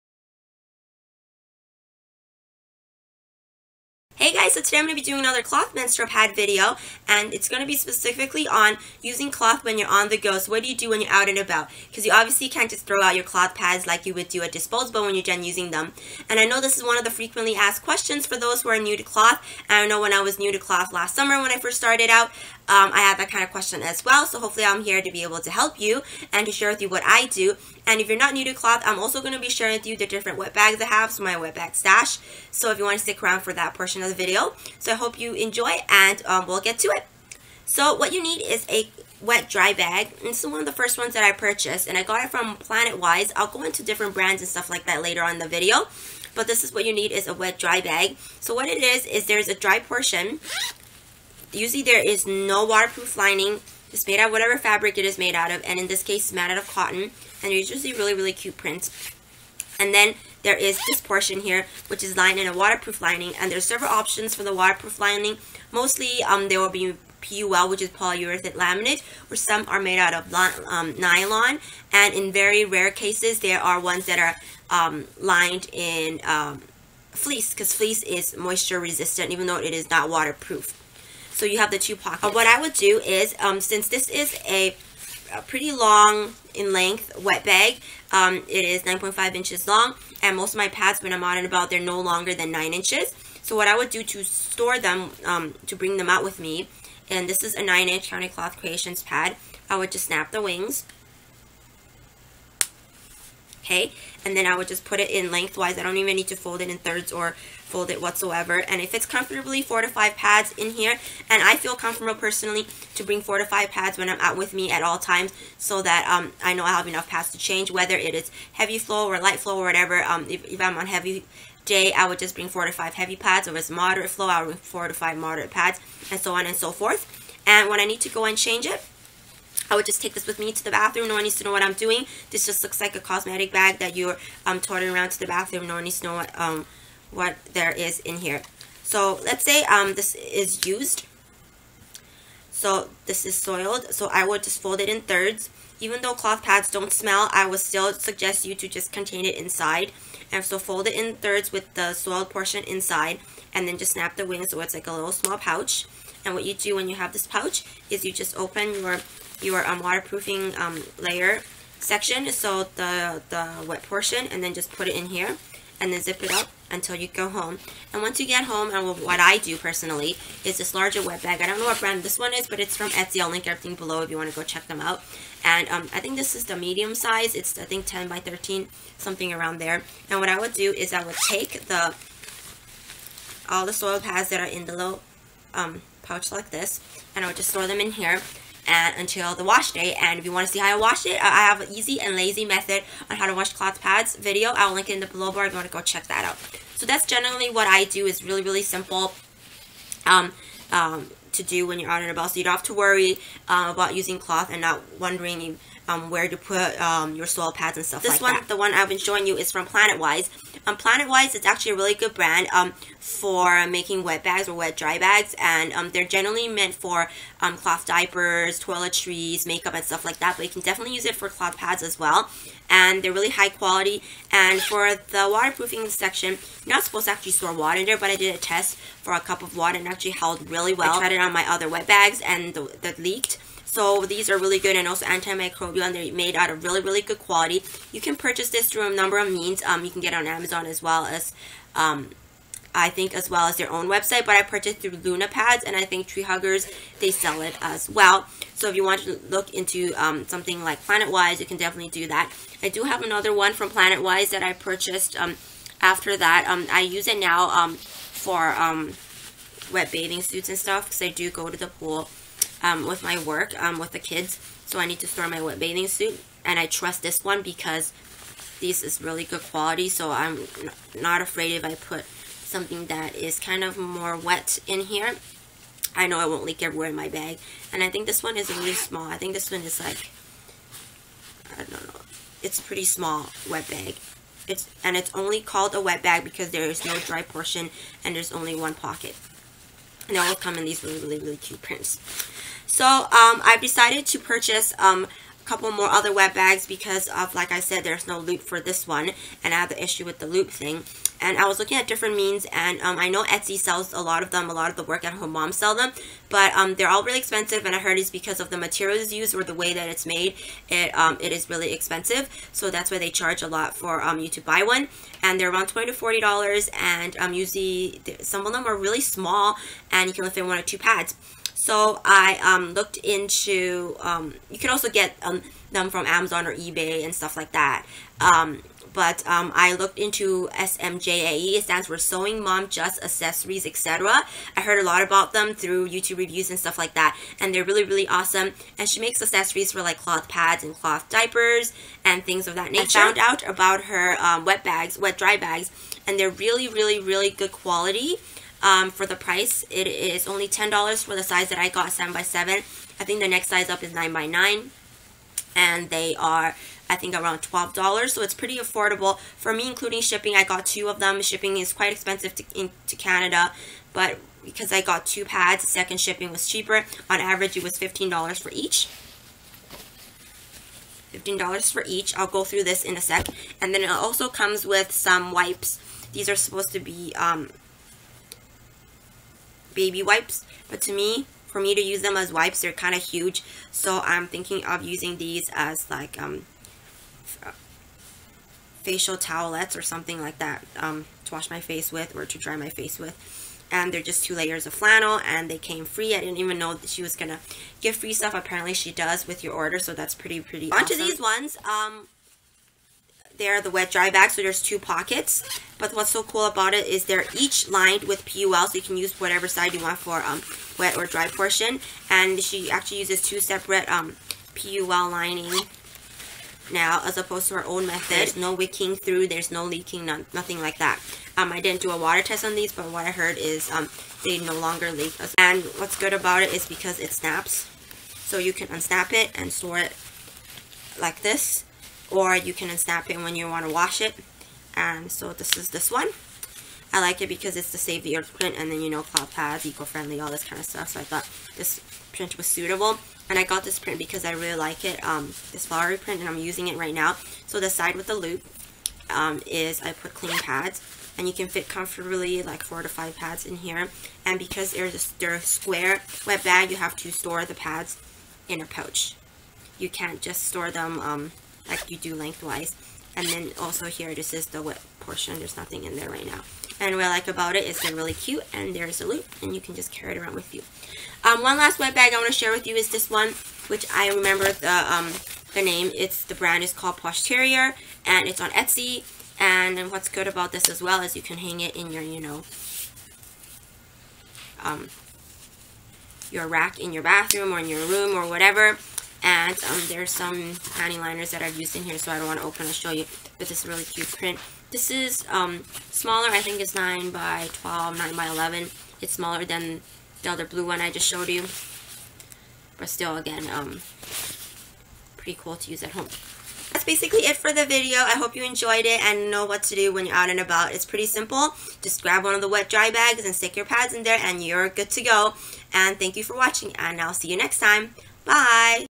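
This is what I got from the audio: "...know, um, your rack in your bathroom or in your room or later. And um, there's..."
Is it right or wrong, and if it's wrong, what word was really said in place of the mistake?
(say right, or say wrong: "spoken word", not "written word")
wrong: "whatever", not "later".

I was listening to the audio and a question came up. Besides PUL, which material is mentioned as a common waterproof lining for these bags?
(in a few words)
nylon.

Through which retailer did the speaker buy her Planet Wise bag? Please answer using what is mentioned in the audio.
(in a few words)
Lunapads.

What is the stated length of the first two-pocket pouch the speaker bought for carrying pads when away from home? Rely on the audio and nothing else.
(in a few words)
9.5 inches.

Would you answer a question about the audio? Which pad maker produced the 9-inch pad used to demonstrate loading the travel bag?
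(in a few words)
County Cloth Creations.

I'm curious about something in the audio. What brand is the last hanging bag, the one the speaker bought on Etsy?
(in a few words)
Poshteriors.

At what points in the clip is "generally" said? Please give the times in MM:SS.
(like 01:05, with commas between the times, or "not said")
03:17, 03:36.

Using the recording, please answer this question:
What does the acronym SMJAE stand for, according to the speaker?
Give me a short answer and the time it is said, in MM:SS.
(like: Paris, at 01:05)
Sewing Mom Just Accessories, etc., at 05:31.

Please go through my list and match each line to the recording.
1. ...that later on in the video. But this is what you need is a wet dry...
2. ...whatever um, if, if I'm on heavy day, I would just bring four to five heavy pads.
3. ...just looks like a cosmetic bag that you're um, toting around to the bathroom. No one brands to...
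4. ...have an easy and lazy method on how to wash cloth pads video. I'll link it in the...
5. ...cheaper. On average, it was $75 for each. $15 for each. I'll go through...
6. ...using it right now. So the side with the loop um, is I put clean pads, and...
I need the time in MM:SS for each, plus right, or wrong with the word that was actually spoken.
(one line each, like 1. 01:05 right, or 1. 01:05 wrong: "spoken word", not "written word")
1. 00:44 right
2. 01:59 right
3. 02:12 wrong: "needs", not "brands"
4. 03:11 right
5. 06:06 wrong: "15", not "75"
6. 07:26 right.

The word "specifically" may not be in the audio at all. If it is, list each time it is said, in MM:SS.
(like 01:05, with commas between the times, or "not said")
00:07.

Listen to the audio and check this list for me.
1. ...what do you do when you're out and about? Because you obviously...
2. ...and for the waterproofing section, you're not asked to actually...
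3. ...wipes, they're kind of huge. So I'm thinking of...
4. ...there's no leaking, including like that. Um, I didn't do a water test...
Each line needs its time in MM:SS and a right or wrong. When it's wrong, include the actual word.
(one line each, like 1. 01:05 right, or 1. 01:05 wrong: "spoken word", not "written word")
1. 00:10 right
2. 03:44 wrong: "supposed", not "asked"
3. 06:22 right
4. 06:59 wrong: "nothing", not "including".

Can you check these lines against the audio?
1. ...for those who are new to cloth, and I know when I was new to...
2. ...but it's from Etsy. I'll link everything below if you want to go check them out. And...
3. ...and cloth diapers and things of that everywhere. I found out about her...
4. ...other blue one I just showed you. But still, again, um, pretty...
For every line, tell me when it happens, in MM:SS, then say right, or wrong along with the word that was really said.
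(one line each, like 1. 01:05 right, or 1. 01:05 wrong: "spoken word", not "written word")
1. 00:18 right
2. 02:52 right
3. 05:40 wrong: "nature", not "everywhere"
4. 08:20 right.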